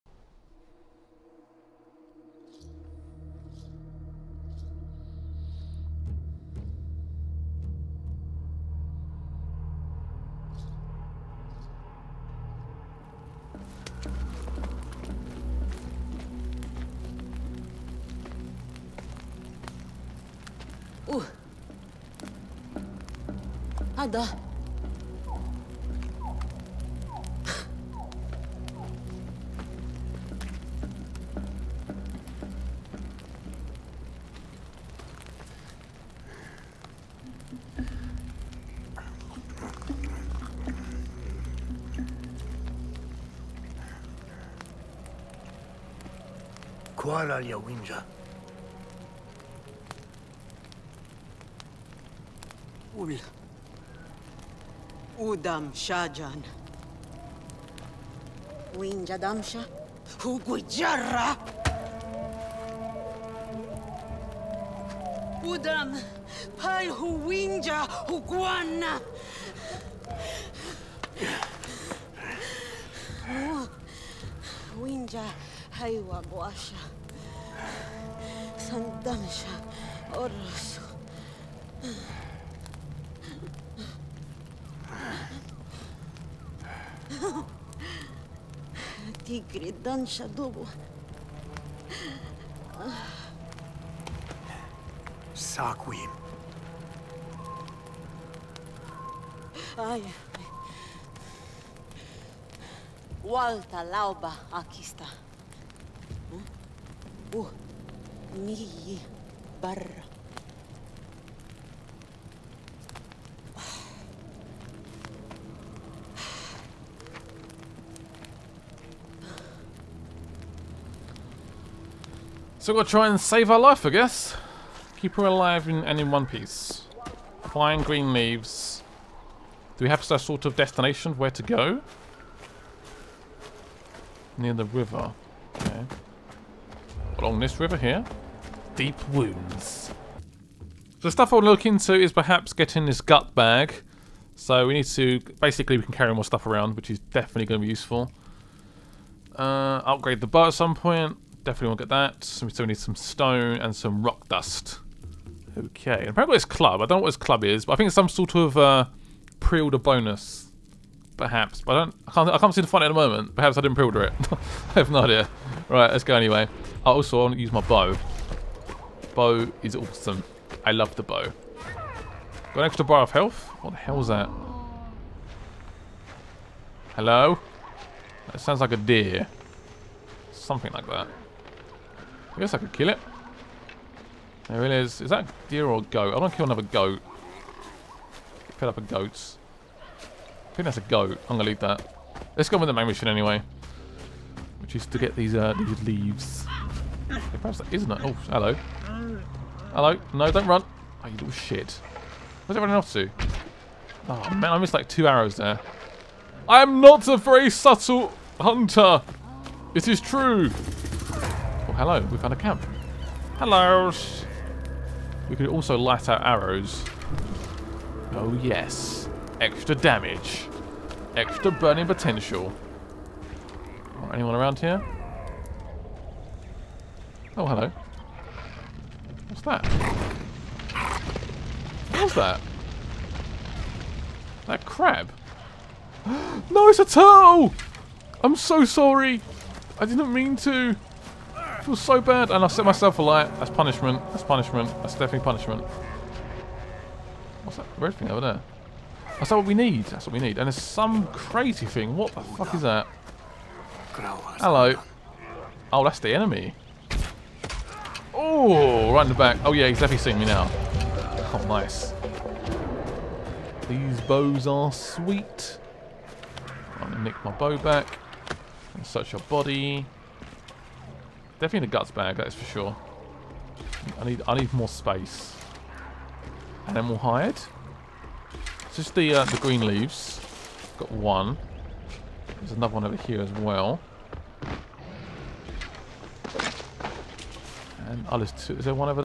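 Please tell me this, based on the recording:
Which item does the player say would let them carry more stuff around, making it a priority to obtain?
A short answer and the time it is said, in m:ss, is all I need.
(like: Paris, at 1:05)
Gut bag, at 2:23.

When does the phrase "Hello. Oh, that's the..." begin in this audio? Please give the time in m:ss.
4:13.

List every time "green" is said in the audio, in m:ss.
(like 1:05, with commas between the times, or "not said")
2:07, 4:39.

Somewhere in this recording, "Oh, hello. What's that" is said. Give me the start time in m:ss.
3:47.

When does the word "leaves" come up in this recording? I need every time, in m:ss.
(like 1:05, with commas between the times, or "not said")
2:08, 3:11, 3:15, 4:39.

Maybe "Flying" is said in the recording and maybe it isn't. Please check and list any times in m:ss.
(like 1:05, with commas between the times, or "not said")
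2:07.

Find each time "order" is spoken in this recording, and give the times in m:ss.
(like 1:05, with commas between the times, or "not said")
2:39, 2:43.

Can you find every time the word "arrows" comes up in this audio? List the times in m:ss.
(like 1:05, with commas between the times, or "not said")
3:25, 3:36.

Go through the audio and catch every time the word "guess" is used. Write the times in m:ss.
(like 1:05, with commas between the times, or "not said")
2:03, 3:02.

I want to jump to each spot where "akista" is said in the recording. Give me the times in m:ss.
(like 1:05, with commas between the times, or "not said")
1:44.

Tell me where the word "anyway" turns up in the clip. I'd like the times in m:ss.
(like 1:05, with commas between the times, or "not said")
2:46, 3:13.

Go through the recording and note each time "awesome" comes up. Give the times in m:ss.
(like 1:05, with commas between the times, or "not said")
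2:49.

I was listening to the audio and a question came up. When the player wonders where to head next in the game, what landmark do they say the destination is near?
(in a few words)
The river.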